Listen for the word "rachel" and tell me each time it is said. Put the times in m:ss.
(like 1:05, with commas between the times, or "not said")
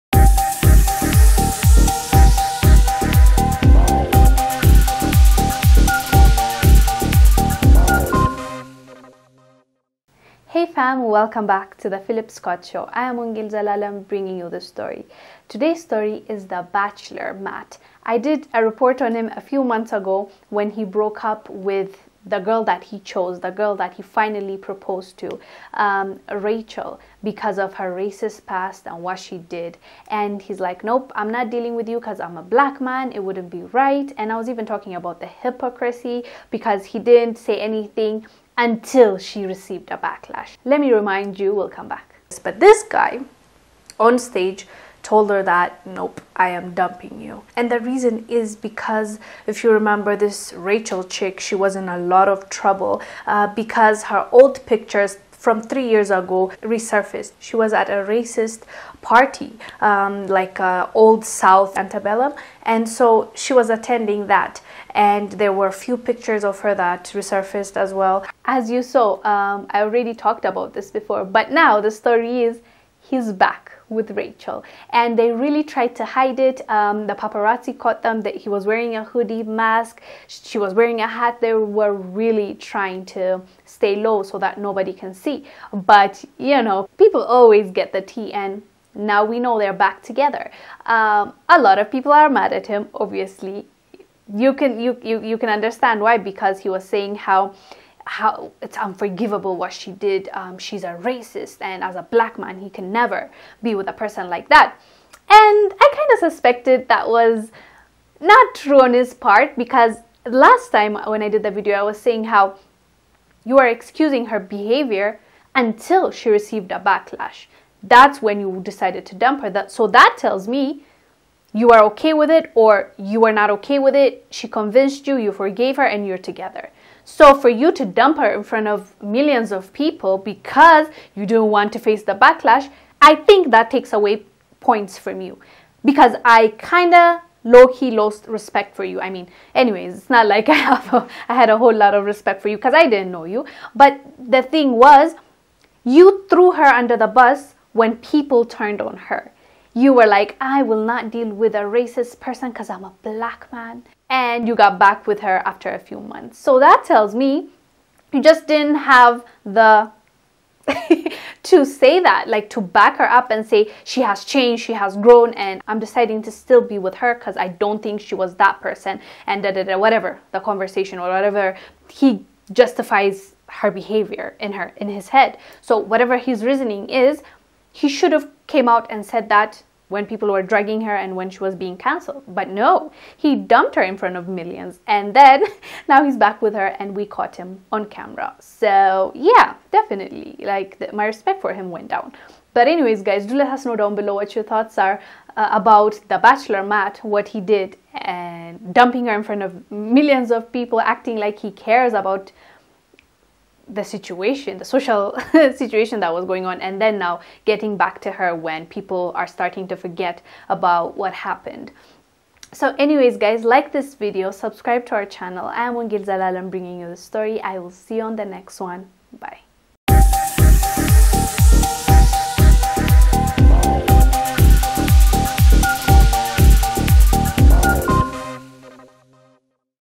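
0:26, 0:50, 1:14.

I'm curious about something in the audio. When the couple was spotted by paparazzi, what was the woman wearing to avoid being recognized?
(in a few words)
a hat.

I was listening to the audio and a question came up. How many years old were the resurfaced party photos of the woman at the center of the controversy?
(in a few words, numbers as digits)
3.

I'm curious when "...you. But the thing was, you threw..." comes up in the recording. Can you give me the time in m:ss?
2:23.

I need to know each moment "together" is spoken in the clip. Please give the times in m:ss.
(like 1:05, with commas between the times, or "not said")
1:30, 2:06.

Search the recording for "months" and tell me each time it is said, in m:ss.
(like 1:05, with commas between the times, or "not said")
0:19, 2:36.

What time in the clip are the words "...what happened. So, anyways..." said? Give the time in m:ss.
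3:30.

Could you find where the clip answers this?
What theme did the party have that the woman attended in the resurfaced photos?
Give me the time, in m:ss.
1:00.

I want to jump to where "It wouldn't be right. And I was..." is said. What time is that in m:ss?
0:33.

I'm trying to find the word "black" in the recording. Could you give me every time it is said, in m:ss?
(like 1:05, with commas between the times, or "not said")
0:32, 1:42, 2:33.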